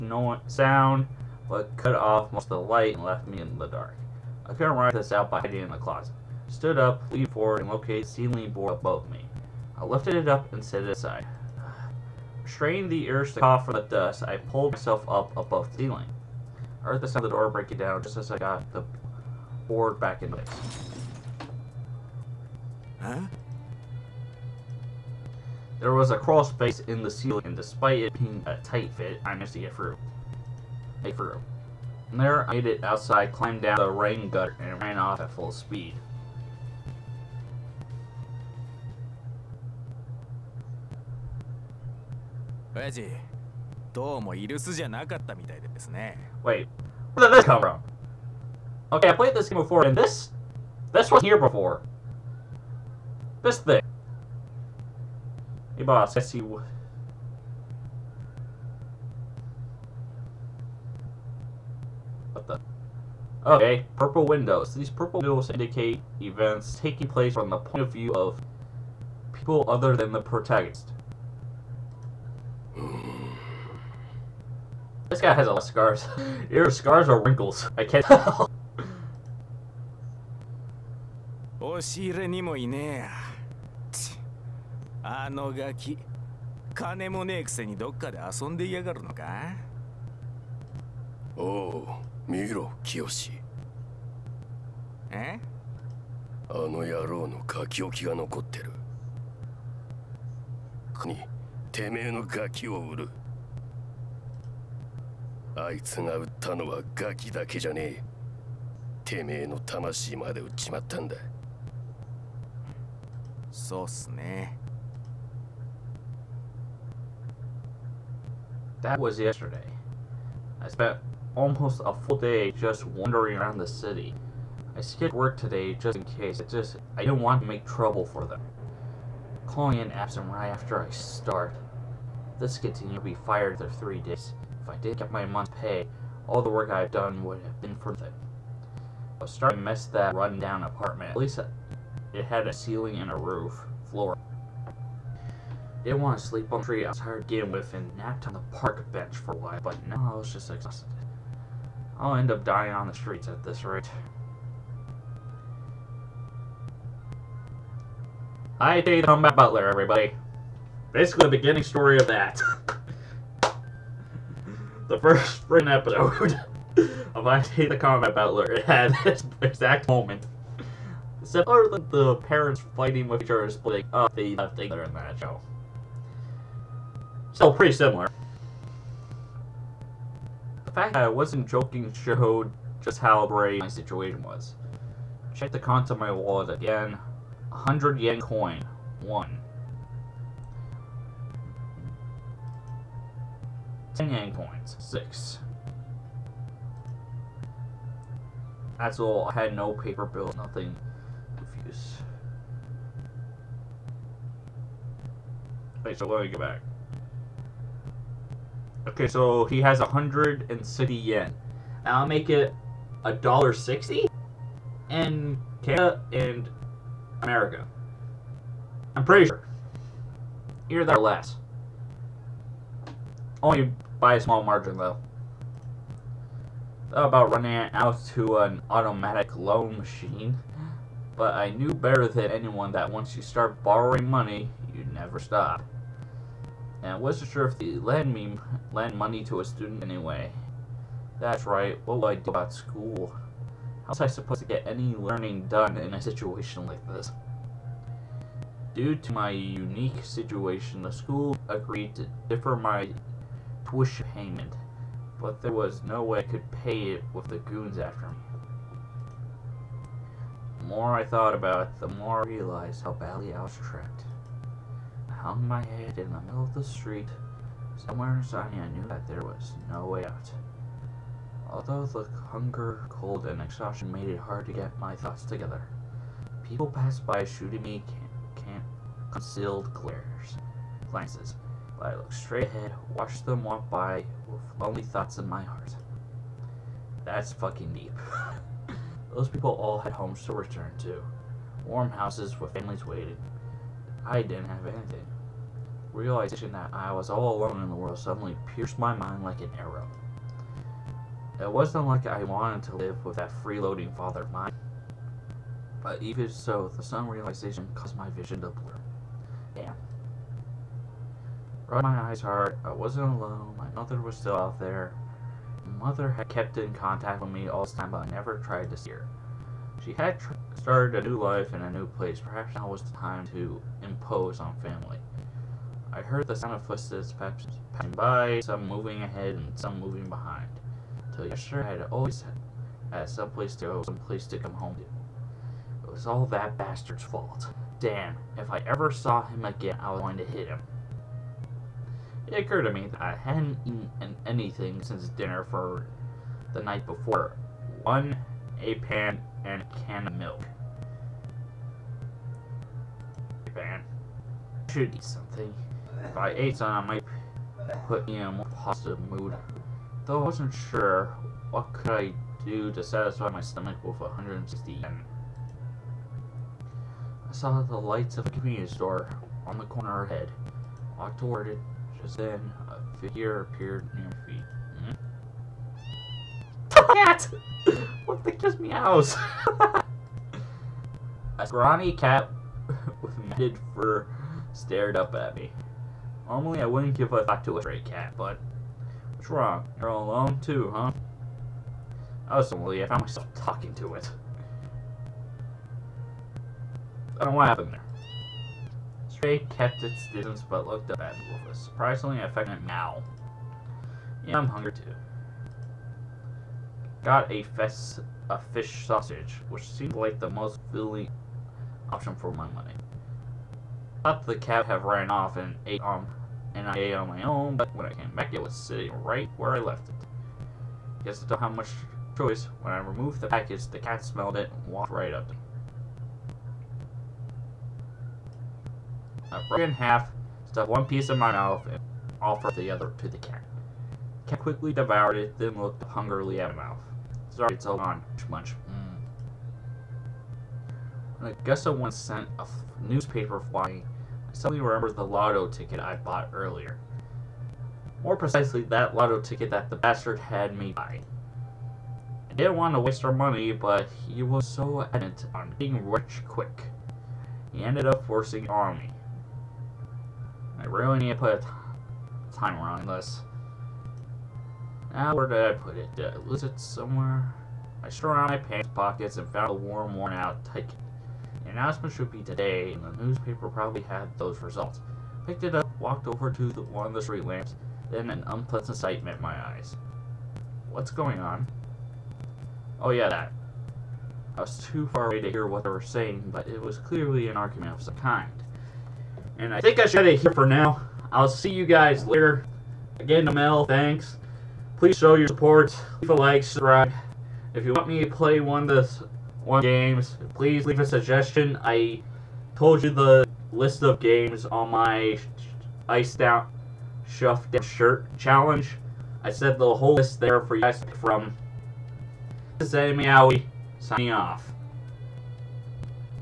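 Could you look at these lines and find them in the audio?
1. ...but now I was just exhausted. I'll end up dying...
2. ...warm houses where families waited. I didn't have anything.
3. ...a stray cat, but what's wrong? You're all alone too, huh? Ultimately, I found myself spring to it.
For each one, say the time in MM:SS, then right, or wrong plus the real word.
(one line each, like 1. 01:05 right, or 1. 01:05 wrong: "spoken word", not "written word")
1. 02:29 right
2. 04:51 right
3. 06:27 wrong: "talking", not "spring".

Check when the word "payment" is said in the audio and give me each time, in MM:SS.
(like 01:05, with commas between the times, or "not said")
04:14.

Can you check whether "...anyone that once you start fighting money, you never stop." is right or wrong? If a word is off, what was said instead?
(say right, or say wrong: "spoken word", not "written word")
wrong: "borrowing", not "fighting".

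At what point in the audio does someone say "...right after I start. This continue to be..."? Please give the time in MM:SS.
02:10.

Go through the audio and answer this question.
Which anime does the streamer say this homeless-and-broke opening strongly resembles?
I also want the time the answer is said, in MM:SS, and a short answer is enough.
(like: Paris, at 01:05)
Hayate the Combat Butler, at 02:47.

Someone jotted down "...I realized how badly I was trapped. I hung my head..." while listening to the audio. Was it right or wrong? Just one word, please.
right.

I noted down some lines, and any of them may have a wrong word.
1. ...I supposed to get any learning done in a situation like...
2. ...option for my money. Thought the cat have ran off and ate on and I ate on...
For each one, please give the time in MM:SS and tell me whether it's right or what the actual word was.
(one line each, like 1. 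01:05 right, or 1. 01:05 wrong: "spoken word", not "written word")
1. 04:04 right
2. 06:51 right.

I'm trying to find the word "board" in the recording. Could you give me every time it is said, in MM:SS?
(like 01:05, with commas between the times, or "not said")
00:08, 00:19.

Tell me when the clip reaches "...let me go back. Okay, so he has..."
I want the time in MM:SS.
03:26.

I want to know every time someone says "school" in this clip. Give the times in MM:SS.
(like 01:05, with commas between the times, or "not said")
04:02, 04:10.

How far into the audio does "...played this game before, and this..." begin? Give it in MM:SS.
00:49.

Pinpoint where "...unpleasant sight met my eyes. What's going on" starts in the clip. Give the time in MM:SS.
07:58.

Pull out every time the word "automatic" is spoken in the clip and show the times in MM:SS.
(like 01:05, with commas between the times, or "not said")
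03:48.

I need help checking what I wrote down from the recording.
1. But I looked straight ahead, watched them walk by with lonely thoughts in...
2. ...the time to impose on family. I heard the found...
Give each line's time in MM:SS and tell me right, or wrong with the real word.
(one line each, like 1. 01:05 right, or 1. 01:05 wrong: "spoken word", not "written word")
1. 04:41 right
2. 05:22 wrong: "sound", not "found".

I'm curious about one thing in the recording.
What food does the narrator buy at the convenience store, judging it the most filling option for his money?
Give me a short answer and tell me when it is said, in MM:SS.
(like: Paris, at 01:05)
Fish sausage, at 06:48.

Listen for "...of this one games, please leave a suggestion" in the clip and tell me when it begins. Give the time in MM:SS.
08:18.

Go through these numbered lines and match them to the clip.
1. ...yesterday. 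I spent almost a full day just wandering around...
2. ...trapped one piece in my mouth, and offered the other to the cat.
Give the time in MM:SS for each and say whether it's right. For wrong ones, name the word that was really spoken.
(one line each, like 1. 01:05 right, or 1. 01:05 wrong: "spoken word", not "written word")
1. 01:59 right
2. 07:10 wrong: "stuffed", not "trapped".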